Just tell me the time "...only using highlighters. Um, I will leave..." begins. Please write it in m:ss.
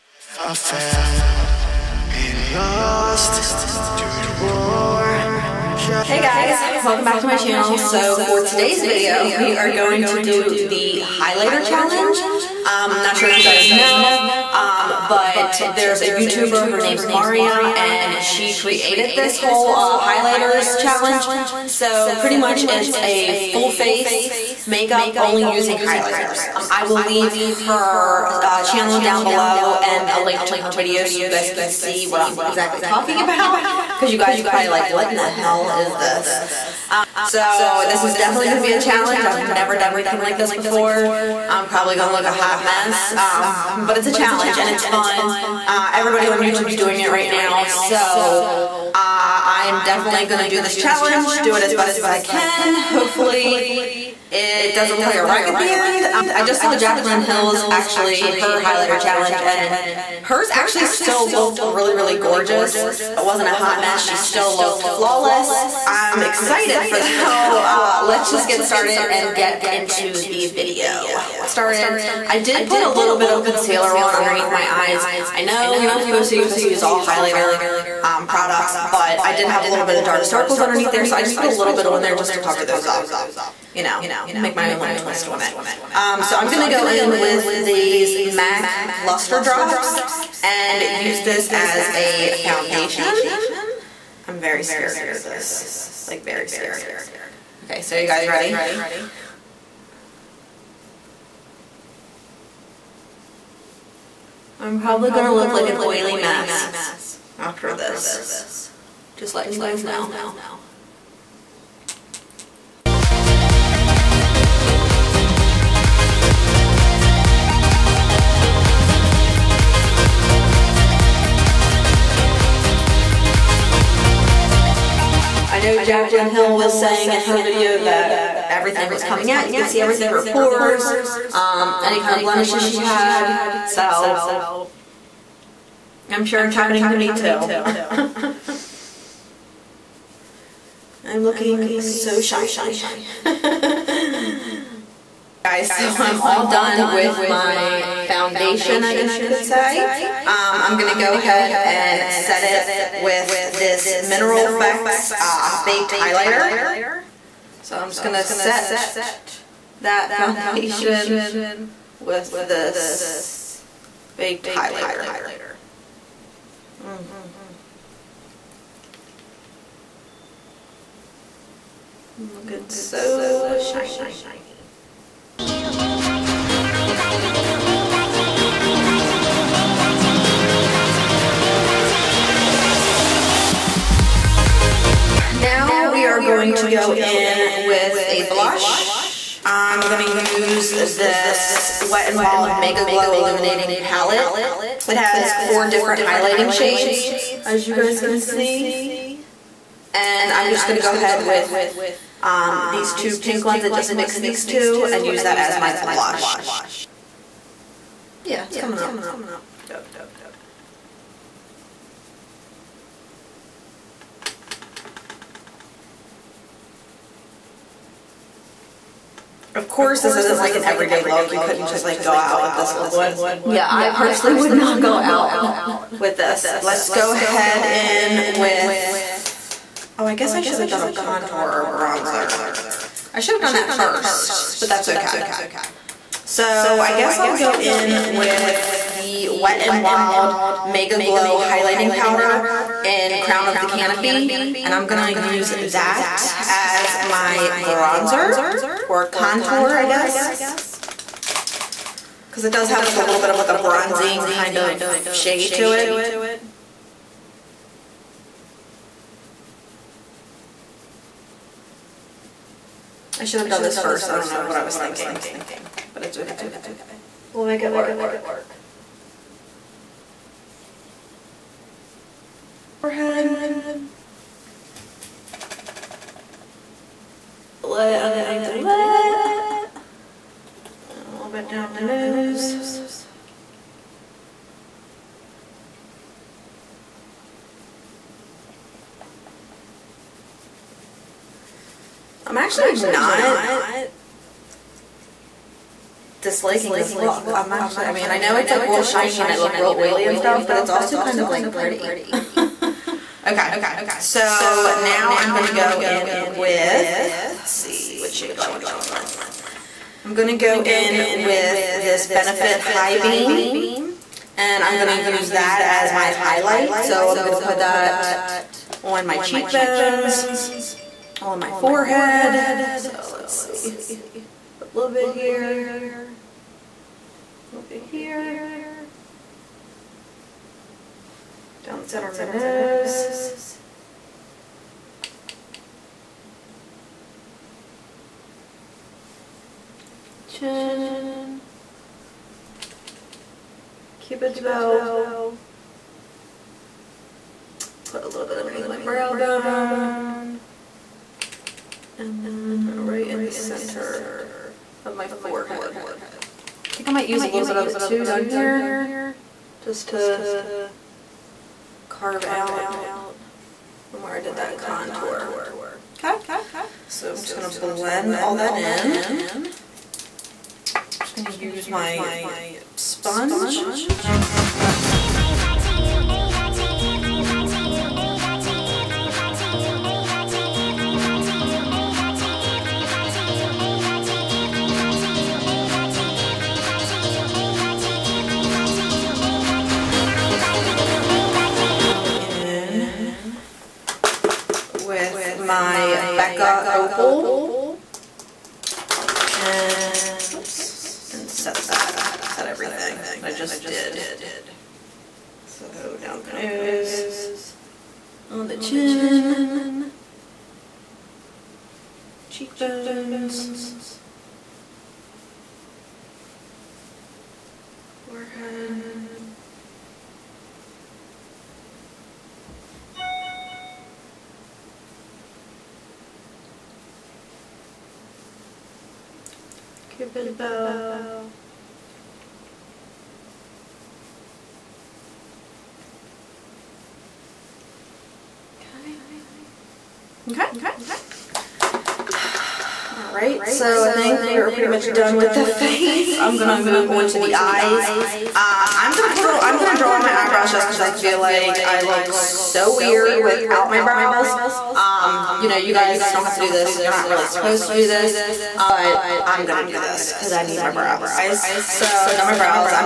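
0:25.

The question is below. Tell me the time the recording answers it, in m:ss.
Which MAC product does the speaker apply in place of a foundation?
1:28.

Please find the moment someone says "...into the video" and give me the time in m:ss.
1:09.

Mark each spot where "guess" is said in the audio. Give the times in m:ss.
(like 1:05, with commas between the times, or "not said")
2:28, 3:50, 3:56, 4:09.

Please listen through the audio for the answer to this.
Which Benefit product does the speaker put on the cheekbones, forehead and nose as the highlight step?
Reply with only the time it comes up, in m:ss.
5:12.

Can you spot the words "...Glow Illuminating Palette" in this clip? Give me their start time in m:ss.
3:12.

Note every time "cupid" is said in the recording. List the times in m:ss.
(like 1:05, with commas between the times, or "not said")
5:43, 7:09.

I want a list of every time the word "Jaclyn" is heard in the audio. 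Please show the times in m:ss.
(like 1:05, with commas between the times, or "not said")
0:56, 2:05.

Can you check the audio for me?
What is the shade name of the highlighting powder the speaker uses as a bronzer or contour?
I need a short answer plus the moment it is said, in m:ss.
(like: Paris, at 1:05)
Crown of the Canopy, at 4:03.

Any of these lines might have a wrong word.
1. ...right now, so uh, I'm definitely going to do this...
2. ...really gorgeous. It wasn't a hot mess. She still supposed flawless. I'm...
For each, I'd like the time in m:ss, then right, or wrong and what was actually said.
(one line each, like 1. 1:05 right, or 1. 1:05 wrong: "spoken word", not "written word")
1. 0:47 right
2. 1:01 wrong: "looked", not "supposed".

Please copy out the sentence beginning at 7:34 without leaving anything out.
Um, you know, you guys don't have to do this.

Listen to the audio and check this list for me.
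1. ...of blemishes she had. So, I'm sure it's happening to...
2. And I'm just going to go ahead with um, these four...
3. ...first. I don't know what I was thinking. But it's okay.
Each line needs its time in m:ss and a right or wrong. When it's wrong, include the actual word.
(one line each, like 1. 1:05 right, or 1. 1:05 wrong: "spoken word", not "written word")
1. 2:12 right
2. 3:19 wrong: "two", not "four"
3. 4:23 right.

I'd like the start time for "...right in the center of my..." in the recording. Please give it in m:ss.
5:52.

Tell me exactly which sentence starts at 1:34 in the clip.
I'm very scared to do this.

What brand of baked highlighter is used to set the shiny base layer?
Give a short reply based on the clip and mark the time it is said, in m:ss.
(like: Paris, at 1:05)
Mineral Effects, at 2:34.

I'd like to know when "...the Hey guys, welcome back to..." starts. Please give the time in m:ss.
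0:05.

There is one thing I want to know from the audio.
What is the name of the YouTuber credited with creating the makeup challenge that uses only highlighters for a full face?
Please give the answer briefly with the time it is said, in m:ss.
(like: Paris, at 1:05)
Mariya, at 0:17.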